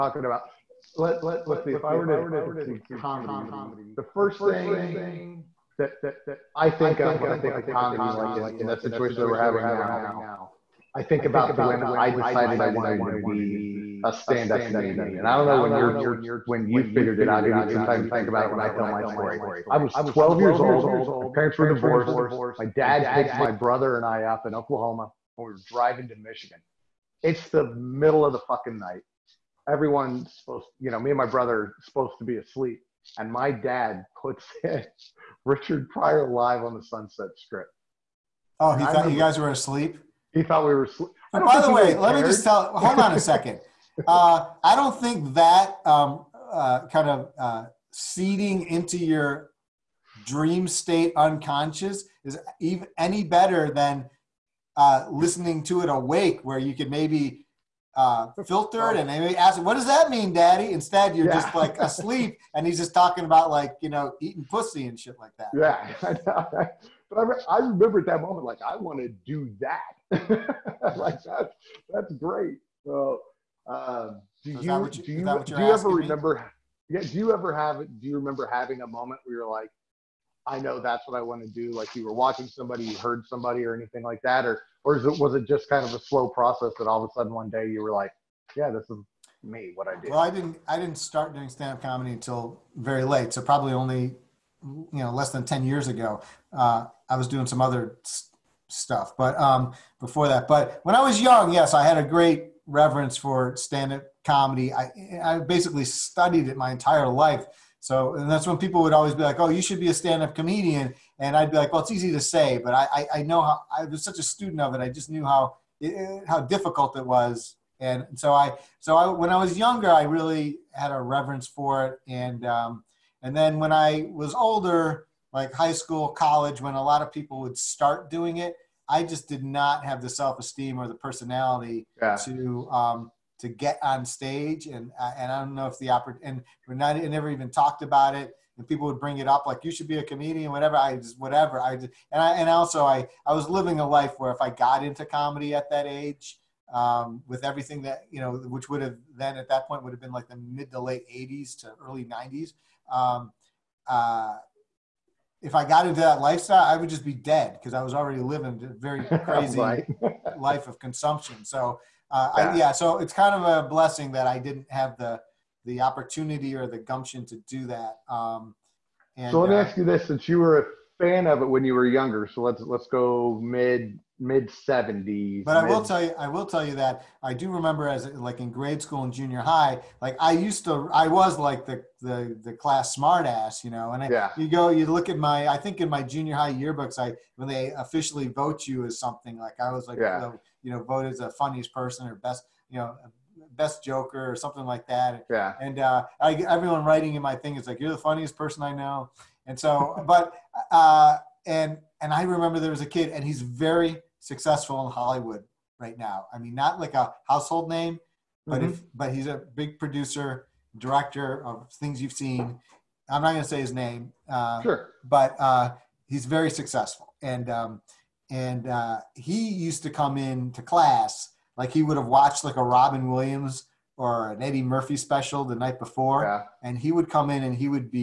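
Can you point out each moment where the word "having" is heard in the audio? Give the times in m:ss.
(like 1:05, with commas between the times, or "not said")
0:09, 1:18.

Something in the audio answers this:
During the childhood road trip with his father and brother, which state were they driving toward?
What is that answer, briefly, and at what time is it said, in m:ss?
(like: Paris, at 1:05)
Michigan, at 0:26.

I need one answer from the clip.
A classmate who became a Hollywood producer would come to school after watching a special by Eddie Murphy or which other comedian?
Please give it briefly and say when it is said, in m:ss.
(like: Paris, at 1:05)
Robin Williams, at 3:42.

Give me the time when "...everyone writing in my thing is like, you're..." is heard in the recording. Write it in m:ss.
3:16.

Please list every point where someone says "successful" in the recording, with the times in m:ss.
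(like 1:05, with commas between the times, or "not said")
3:24, 3:36.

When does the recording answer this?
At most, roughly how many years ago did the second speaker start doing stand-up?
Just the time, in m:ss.
1:35.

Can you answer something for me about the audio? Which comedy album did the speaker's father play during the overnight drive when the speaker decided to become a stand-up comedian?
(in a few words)
Live on the Sunset Strip.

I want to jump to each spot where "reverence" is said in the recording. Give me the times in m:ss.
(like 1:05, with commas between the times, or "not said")
1:42, 2:00.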